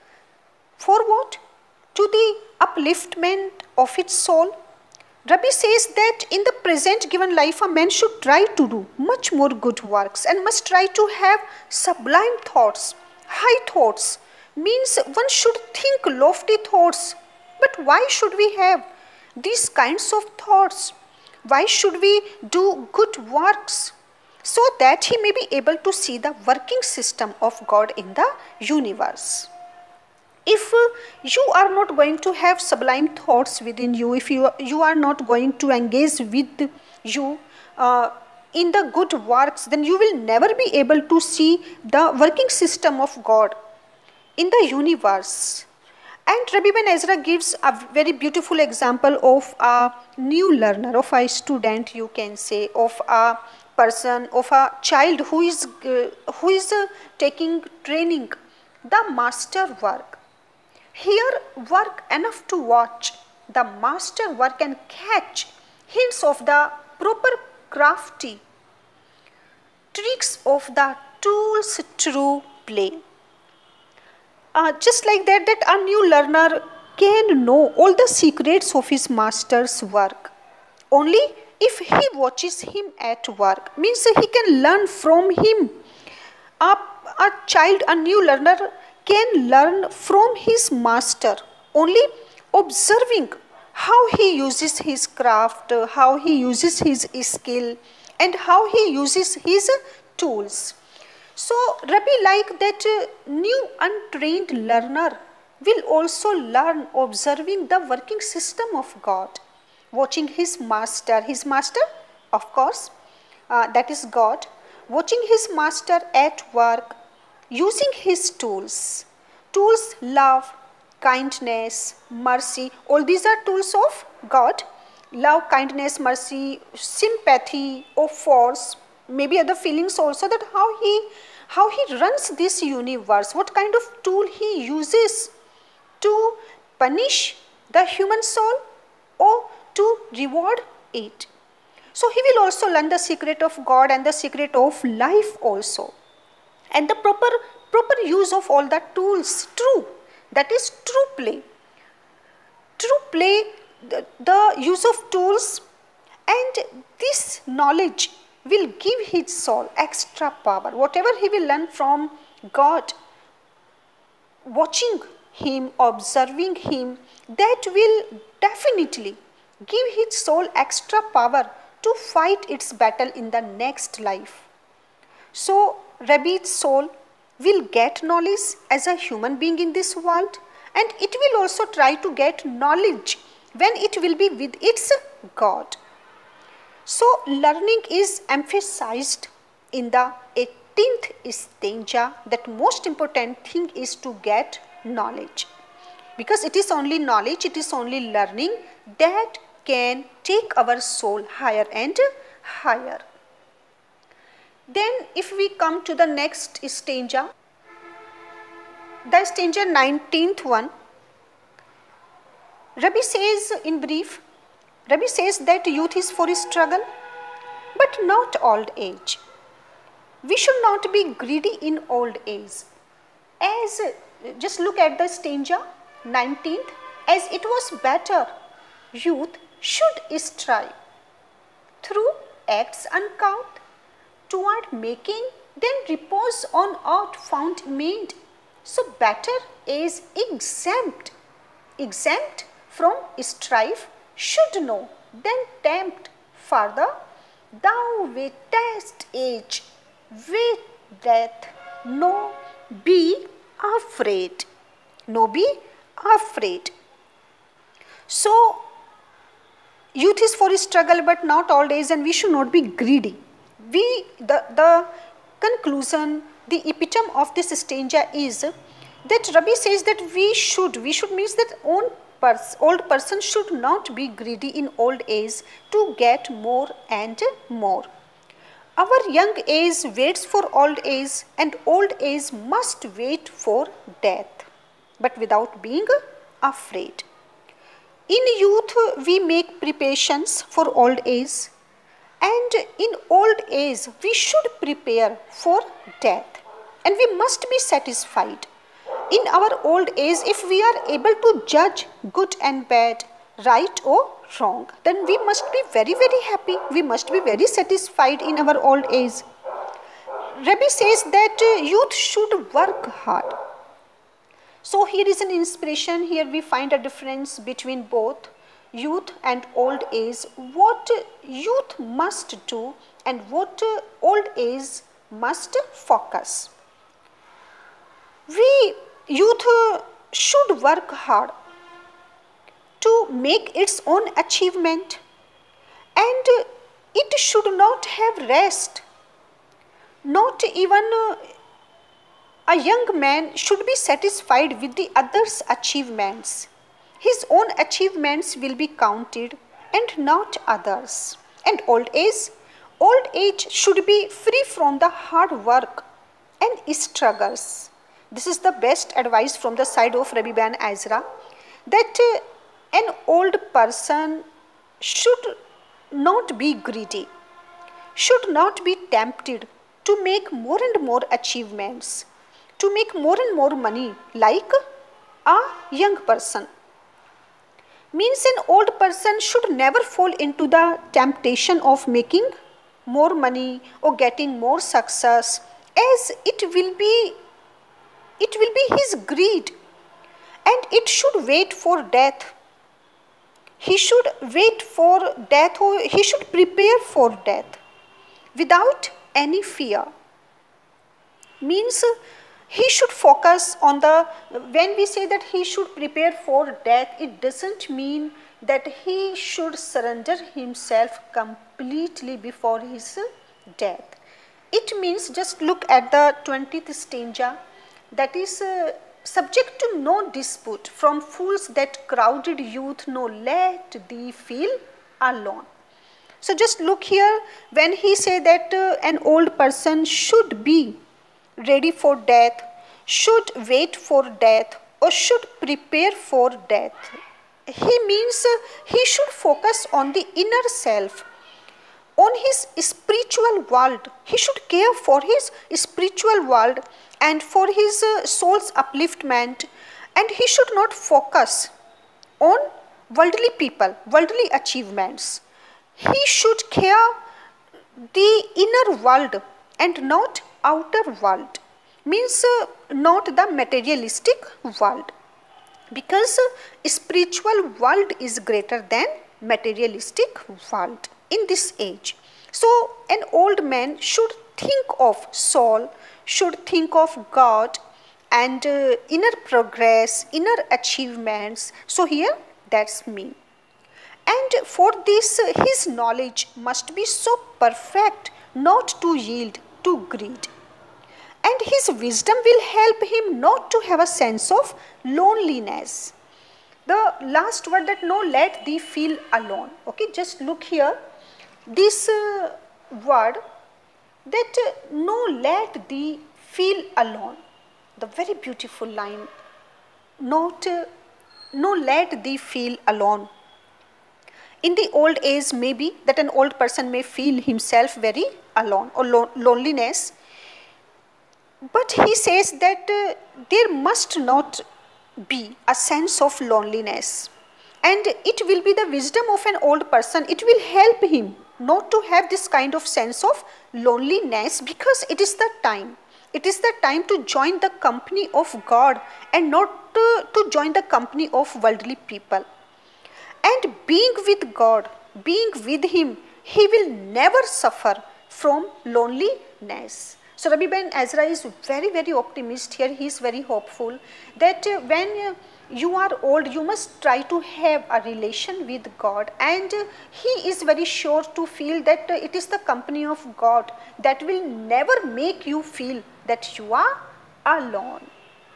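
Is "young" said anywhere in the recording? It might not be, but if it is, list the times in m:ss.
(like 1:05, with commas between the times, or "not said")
4:39, 5:42, 6:15.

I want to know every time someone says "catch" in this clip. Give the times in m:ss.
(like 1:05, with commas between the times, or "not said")
1:04.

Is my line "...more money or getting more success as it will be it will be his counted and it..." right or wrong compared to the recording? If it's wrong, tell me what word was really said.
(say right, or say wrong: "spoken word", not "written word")
wrong: "greed", not "counted".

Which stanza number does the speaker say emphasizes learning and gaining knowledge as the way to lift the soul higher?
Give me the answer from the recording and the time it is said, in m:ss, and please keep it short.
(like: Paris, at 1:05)
18th, at 3:10.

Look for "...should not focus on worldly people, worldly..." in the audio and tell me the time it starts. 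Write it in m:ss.
7:30.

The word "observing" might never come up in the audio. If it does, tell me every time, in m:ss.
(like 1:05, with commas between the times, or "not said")
1:32, 1:47, 2:45.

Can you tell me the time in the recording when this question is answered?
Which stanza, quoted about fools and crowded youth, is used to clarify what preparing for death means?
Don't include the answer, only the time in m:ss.
6:56.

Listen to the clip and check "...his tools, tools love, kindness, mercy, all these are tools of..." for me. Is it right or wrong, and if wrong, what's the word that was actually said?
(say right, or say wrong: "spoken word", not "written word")
right.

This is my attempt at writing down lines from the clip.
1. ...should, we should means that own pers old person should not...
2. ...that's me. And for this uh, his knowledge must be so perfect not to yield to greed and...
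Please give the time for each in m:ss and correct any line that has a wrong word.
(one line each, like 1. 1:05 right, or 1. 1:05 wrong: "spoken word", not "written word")
1. 4:30 right
2. 8:02 right.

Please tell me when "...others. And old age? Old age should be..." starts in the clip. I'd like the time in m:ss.
5:50.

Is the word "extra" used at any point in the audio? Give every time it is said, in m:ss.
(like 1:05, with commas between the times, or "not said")
2:39, 2:50.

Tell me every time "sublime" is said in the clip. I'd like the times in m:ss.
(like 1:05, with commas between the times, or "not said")
0:11, 0:32.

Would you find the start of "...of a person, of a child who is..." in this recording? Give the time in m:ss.
0:52.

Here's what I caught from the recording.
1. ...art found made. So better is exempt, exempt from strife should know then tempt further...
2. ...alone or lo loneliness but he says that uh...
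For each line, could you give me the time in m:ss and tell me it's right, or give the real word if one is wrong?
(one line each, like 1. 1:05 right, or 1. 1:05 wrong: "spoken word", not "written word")
1. 3:56 right
2. 8:38 right.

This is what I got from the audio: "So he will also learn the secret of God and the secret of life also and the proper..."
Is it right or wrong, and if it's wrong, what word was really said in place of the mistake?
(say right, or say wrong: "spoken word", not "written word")
right.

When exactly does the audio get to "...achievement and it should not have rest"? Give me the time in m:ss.
5:34.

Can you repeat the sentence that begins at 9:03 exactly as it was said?
And being with God, being with Him, He will never suffer from loneliness.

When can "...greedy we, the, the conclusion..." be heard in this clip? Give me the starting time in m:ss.
4:22.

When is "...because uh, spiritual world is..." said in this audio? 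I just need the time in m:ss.
7:45.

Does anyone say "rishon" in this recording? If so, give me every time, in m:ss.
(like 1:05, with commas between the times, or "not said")
not said.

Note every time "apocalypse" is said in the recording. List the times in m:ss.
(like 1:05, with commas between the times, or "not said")
not said.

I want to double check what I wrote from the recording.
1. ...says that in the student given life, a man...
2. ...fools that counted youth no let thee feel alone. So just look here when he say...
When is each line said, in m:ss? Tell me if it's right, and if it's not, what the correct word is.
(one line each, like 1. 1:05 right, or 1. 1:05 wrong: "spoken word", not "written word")
1. 0:05 wrong: "present", not "student"
2. 7:01 wrong: "crowded", not "counted".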